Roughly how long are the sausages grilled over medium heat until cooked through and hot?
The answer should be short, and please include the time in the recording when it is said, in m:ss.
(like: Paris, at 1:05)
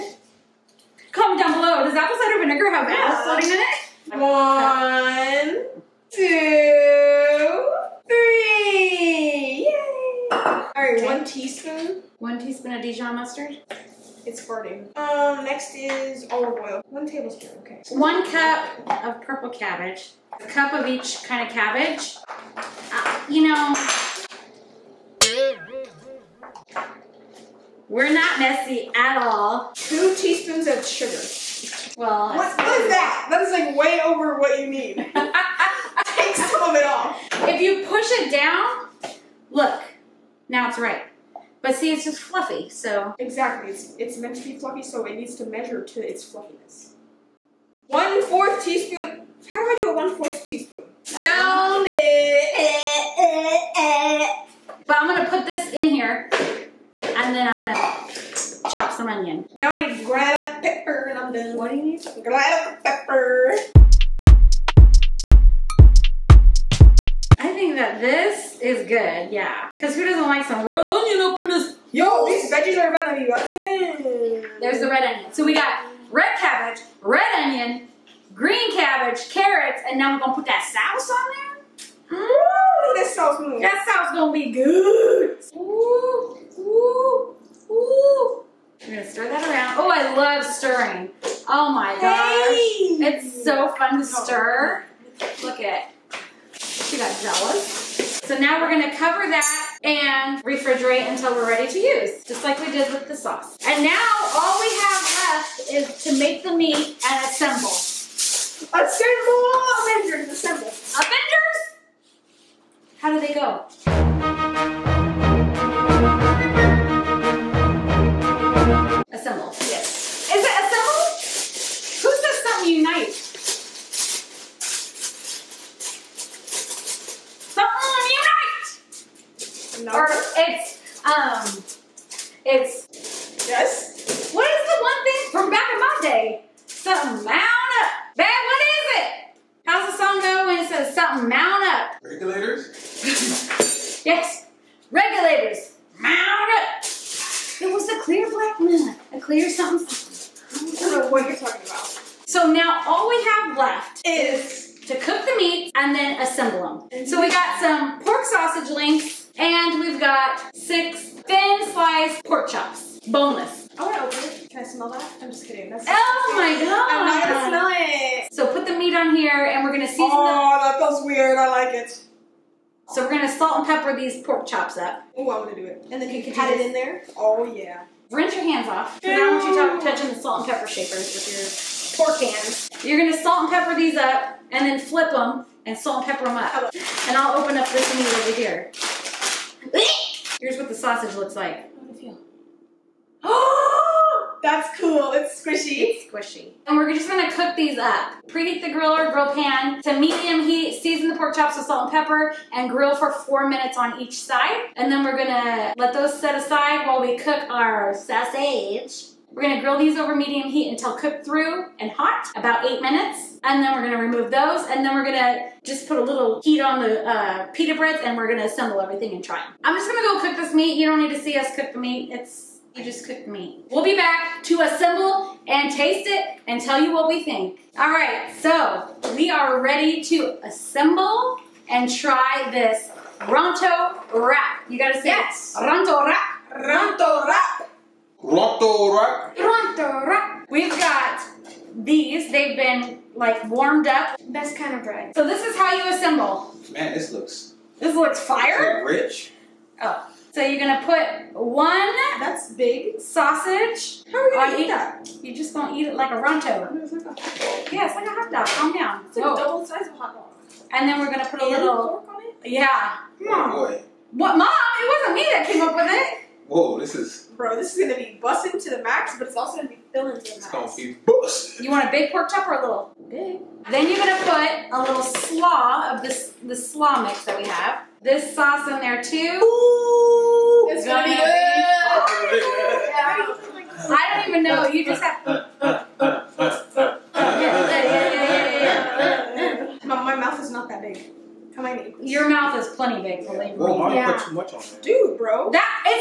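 8 minutes, at 3:32.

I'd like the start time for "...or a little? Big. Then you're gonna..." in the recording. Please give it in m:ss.
4:32.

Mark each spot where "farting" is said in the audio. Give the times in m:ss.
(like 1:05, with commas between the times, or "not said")
0:14.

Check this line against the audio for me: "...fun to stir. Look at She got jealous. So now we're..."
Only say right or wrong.
right.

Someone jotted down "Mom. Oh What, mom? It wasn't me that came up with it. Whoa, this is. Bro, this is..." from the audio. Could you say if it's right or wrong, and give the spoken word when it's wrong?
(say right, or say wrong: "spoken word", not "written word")
right.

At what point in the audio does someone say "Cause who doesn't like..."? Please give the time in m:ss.
1:09.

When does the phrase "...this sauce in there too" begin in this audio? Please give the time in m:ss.
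4:38.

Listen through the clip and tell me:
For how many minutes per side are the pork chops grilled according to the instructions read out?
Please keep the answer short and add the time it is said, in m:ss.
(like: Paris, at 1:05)
4 minutes, at 3:23.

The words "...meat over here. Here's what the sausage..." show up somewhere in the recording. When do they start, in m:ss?
3:07.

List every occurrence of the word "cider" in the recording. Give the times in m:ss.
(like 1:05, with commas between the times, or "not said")
0:02.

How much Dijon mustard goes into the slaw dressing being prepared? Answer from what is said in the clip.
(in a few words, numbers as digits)
1 teaspoon.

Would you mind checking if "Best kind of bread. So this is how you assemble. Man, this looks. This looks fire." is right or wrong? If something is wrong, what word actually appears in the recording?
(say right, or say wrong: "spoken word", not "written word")
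right.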